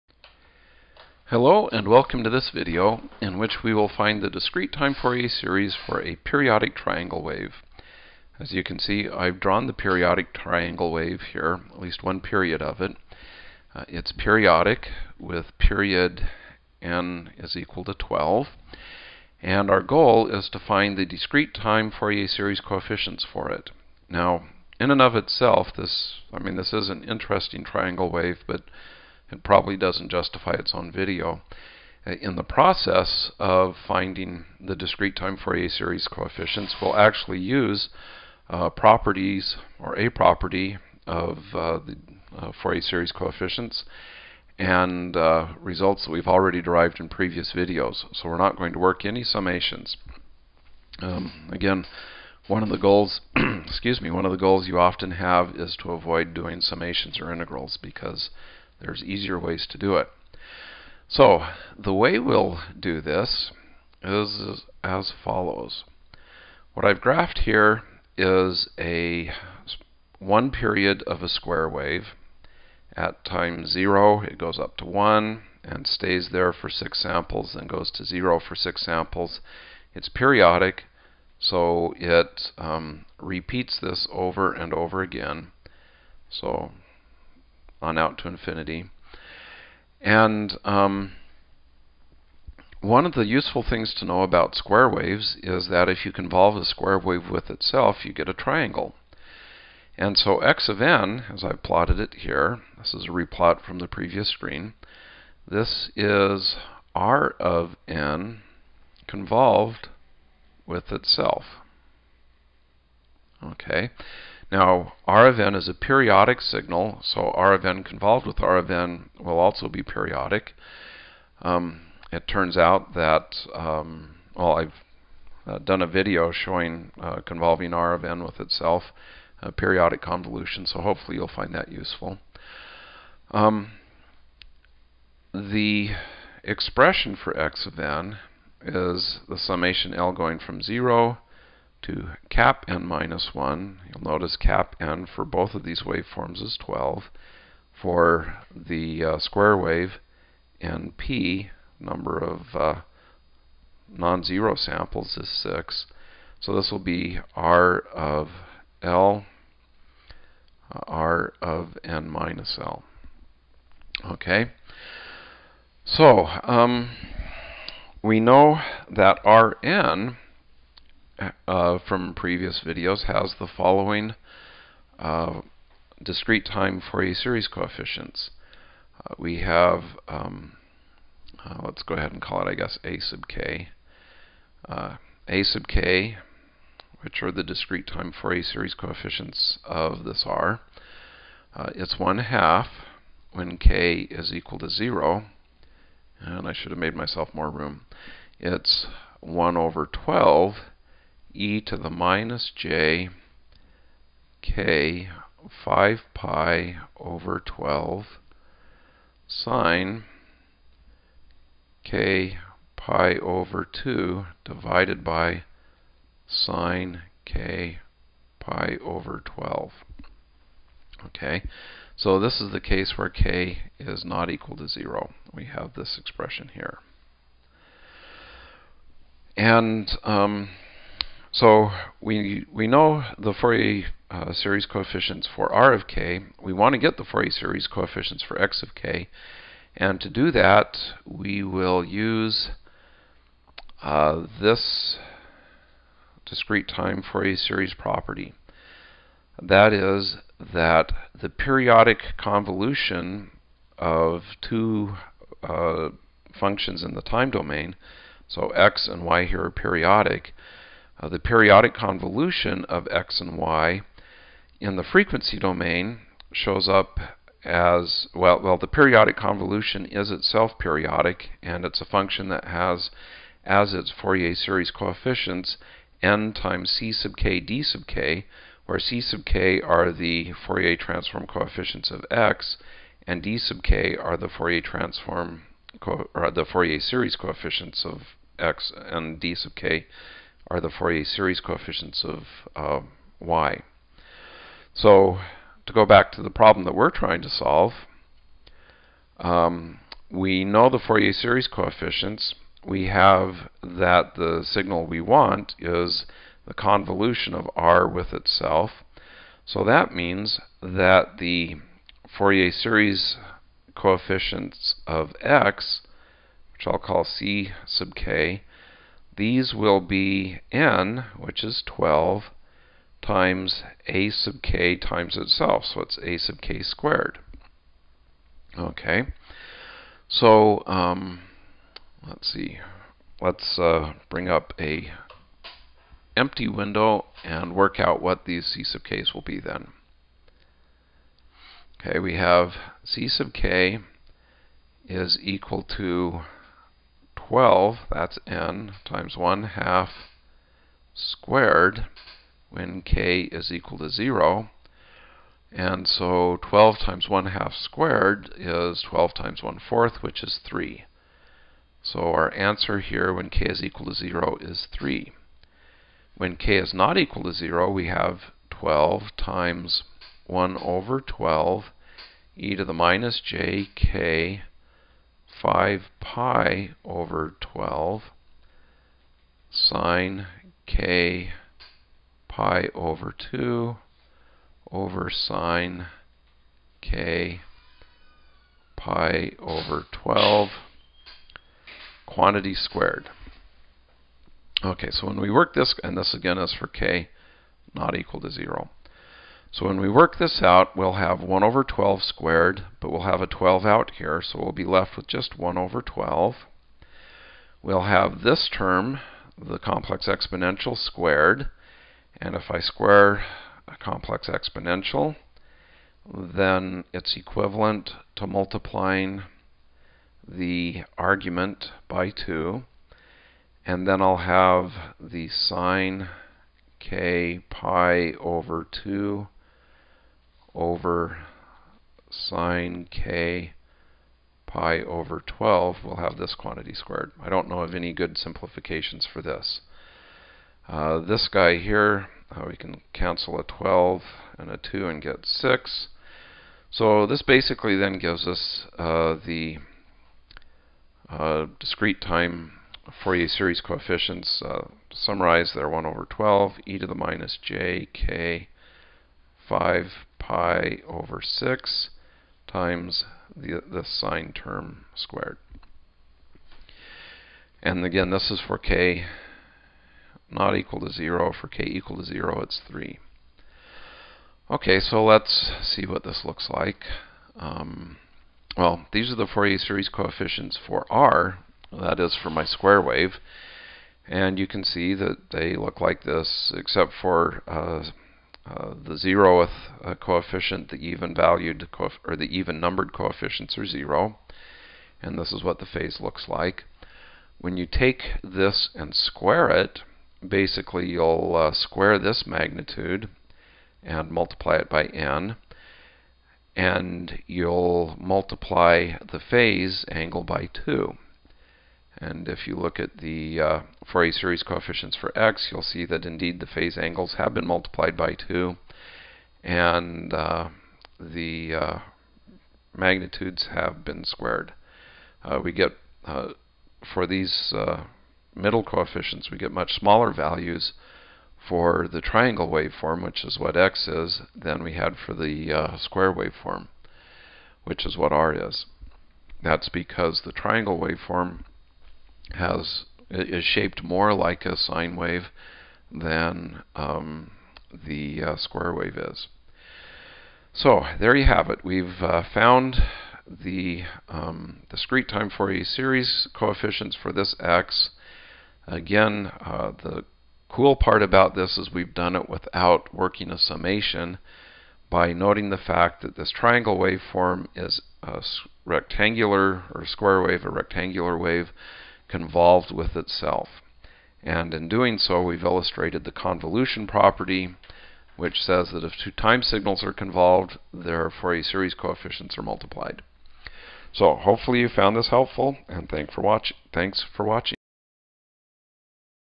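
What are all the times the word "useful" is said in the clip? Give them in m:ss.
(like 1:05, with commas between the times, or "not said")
1:33, 2:11.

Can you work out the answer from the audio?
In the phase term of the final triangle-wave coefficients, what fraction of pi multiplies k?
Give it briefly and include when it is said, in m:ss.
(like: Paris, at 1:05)
5/6, at 7:39.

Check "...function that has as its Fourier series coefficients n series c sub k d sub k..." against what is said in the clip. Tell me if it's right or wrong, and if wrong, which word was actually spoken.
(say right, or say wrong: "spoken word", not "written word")
wrong: "times", not "series".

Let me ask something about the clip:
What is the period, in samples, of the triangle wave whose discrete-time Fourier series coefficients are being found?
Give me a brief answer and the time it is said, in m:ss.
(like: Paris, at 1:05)
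12, at 0:15.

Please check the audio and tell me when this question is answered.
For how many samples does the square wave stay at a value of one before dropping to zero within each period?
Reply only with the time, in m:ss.
1:15.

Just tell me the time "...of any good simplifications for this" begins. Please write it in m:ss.
7:17.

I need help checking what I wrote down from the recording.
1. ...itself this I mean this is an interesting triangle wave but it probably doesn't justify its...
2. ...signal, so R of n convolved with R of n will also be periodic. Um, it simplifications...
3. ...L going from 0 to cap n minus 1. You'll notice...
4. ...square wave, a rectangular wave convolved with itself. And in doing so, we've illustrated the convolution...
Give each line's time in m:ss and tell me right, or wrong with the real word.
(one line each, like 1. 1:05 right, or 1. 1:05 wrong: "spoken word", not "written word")
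1. 0:25 right
2. 1:56 wrong: "turns", not "simplifications"
3. 2:19 right
4. 9:29 right.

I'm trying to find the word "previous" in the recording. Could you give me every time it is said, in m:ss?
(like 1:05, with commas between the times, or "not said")
0:47, 1:43, 2:52.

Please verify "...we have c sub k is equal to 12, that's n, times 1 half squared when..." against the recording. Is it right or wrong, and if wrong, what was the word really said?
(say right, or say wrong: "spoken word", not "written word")
right.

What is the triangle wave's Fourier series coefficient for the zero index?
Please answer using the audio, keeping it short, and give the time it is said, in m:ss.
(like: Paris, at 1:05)
3, at 6:02.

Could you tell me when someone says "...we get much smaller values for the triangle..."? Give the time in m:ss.
8:49.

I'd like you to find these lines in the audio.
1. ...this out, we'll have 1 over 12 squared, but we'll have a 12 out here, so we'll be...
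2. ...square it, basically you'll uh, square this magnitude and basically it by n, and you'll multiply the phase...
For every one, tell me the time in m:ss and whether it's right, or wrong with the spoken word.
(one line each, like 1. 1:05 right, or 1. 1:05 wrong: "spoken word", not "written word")
1. 6:40 right
2. 8:18 wrong: "multiply", not "basically".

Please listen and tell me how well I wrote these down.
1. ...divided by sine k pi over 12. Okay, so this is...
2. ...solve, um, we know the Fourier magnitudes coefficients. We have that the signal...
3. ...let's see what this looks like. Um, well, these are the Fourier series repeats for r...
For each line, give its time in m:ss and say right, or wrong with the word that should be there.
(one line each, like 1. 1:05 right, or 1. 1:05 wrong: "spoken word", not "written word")
1. 3:34 right
2. 4:57 wrong: "series", not "magnitudes"
3. 7:55 wrong: "coefficients", not "repeats".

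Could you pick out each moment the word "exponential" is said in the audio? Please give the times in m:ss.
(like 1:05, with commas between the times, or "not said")
6:50, 6:54.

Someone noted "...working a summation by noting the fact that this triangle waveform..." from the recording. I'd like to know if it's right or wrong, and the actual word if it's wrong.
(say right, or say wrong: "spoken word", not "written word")
right.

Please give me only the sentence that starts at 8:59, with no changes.
That's because the triangle waveform has is shaped more like a sine wave than um, the uh, square wave is.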